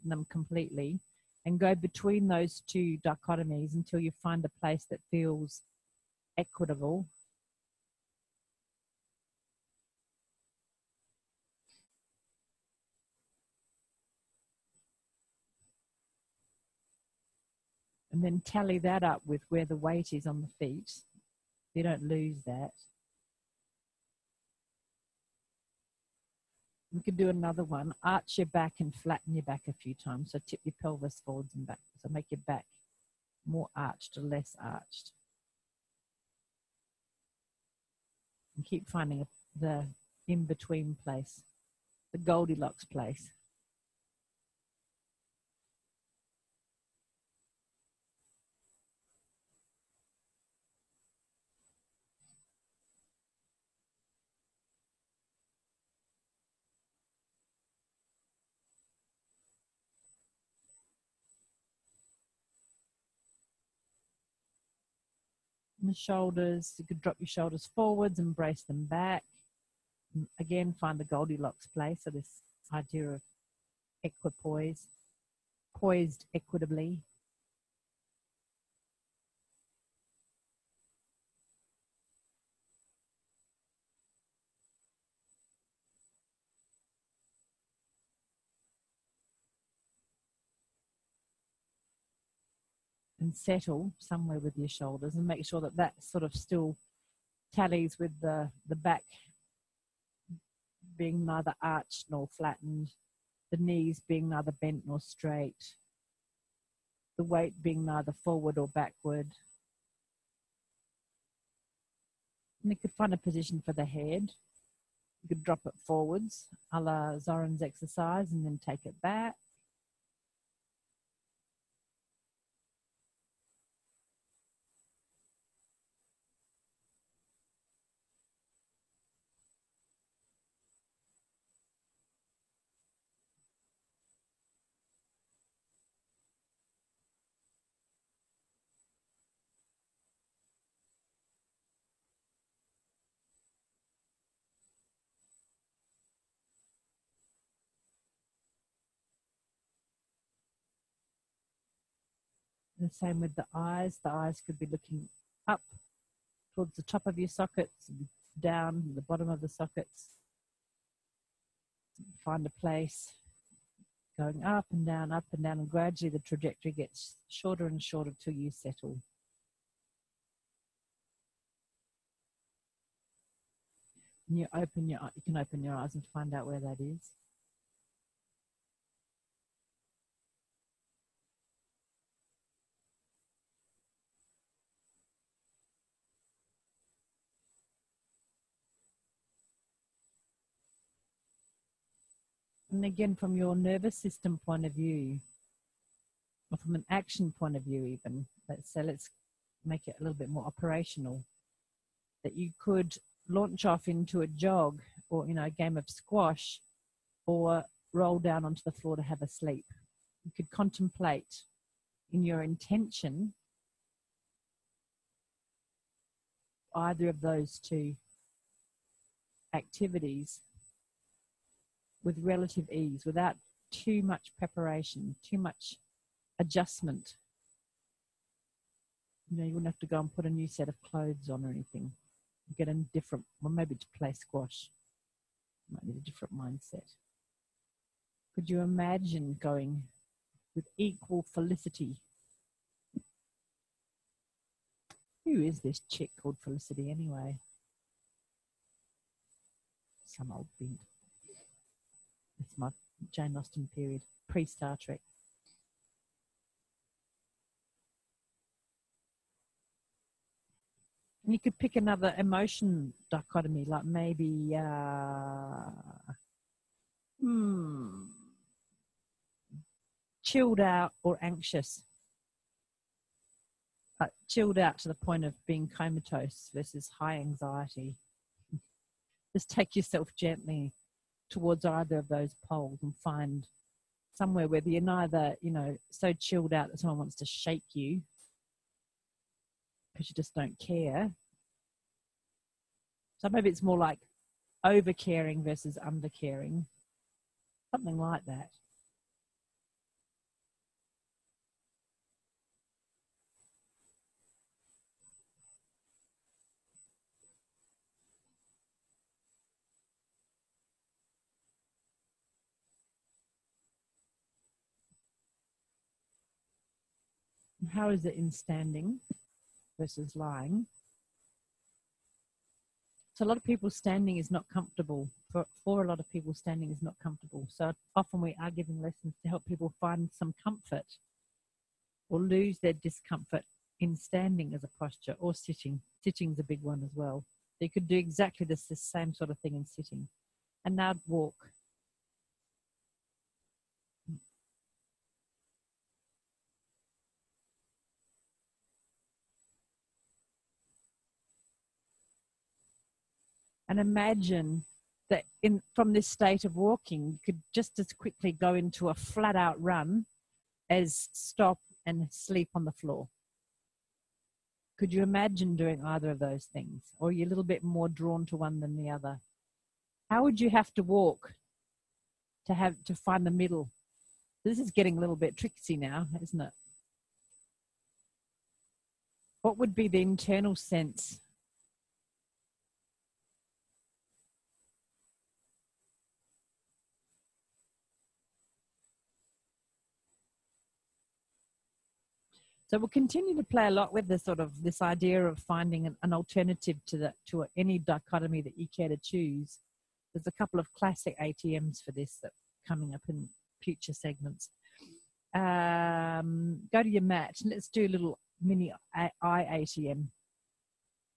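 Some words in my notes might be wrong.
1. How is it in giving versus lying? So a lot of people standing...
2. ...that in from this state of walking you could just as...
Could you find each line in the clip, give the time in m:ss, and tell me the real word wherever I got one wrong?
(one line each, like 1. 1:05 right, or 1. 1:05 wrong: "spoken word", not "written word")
1. 5:17 wrong: "standing", not "giving"
2. 5:55 right.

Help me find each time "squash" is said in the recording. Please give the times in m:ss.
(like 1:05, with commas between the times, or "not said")
3:25, 3:54.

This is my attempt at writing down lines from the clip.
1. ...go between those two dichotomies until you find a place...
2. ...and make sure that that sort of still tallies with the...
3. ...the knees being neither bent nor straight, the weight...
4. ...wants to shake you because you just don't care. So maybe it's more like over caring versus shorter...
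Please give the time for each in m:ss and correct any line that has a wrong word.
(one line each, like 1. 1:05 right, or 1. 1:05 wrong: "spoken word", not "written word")
1. 0:01 right
2. 1:35 right
3. 1:43 right
4. 4:46 wrong: "under", not "shorter".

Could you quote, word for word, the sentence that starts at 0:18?
And then tally that up with where the weight is on the feet.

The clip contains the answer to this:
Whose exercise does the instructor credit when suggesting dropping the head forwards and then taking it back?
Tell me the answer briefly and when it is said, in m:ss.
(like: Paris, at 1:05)
Zoran, at 1:57.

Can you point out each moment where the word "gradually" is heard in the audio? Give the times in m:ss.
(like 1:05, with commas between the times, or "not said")
2:45.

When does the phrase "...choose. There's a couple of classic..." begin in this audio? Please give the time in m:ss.
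6:39.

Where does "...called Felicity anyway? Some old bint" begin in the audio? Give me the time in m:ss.
4:06.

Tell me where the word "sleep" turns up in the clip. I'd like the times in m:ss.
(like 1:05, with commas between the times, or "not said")
3:29, 6:02.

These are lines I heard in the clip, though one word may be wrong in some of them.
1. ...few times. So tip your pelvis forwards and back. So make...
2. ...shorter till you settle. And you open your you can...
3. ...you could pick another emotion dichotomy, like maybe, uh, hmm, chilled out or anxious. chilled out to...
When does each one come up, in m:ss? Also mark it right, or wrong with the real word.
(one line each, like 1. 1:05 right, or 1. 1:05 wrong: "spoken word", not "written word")
1. 0:29 right
2. 2:47 right
3. 4:21 right.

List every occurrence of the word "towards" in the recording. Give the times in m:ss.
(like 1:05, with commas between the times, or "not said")
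2:36, 4:41.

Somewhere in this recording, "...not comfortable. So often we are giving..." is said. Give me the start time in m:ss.
5:26.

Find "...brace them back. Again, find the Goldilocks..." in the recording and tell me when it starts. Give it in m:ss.
1:08.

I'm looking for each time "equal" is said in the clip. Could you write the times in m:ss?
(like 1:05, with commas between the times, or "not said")
4:00.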